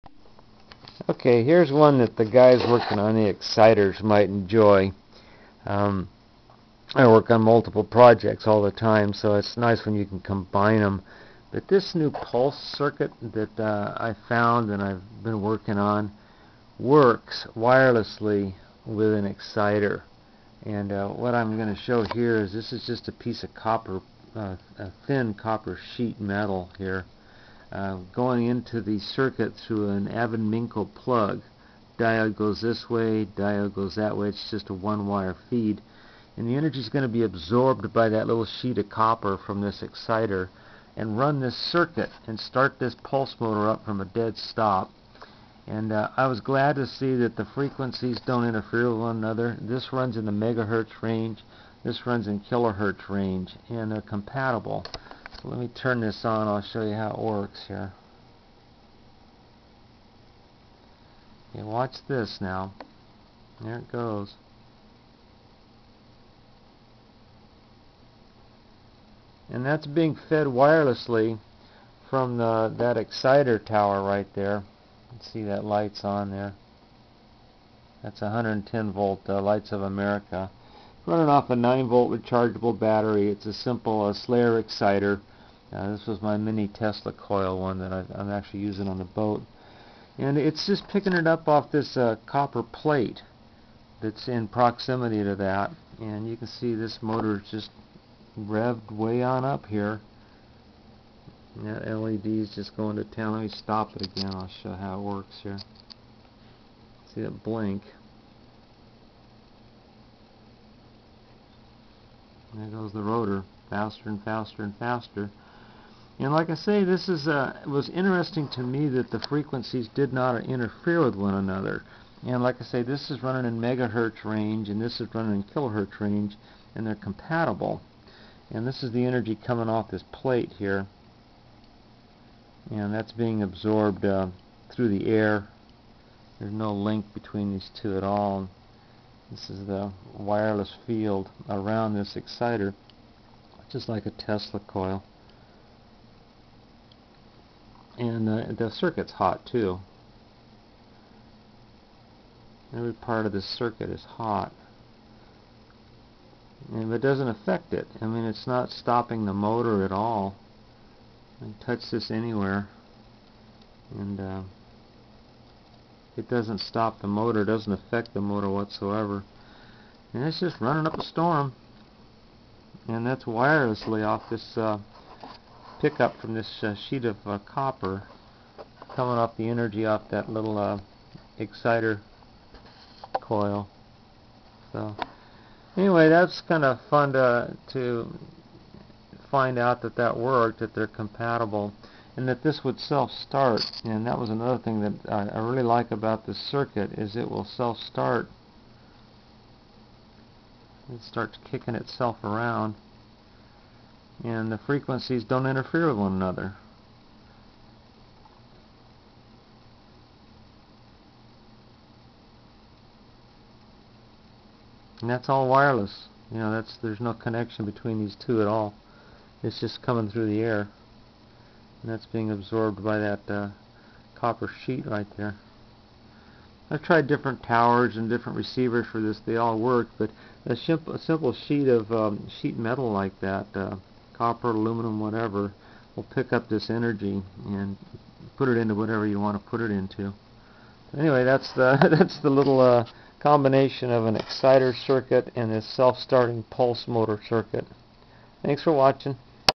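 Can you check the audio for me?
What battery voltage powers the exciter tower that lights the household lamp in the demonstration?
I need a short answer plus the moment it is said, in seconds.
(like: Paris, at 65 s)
9 volt, at 81 s.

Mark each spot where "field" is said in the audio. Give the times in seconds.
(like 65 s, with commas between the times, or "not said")
140 s.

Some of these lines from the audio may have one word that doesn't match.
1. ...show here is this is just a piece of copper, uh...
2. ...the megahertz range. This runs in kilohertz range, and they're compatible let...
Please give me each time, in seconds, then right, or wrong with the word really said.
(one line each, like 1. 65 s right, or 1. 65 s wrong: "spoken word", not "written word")
1. 21 s right
2. 50 s right.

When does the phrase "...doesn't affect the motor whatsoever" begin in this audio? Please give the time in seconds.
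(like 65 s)
167 s.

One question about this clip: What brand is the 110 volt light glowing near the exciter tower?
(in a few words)
Lights of America.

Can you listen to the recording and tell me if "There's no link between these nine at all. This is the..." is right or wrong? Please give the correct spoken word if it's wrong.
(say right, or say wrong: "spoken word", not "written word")
wrong: "two", not "nine".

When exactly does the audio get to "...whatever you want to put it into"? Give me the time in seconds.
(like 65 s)
238 s.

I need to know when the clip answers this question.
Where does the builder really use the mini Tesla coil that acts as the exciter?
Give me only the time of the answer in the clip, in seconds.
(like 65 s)
88 s.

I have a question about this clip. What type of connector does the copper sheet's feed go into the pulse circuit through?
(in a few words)
Avon-Minco plug.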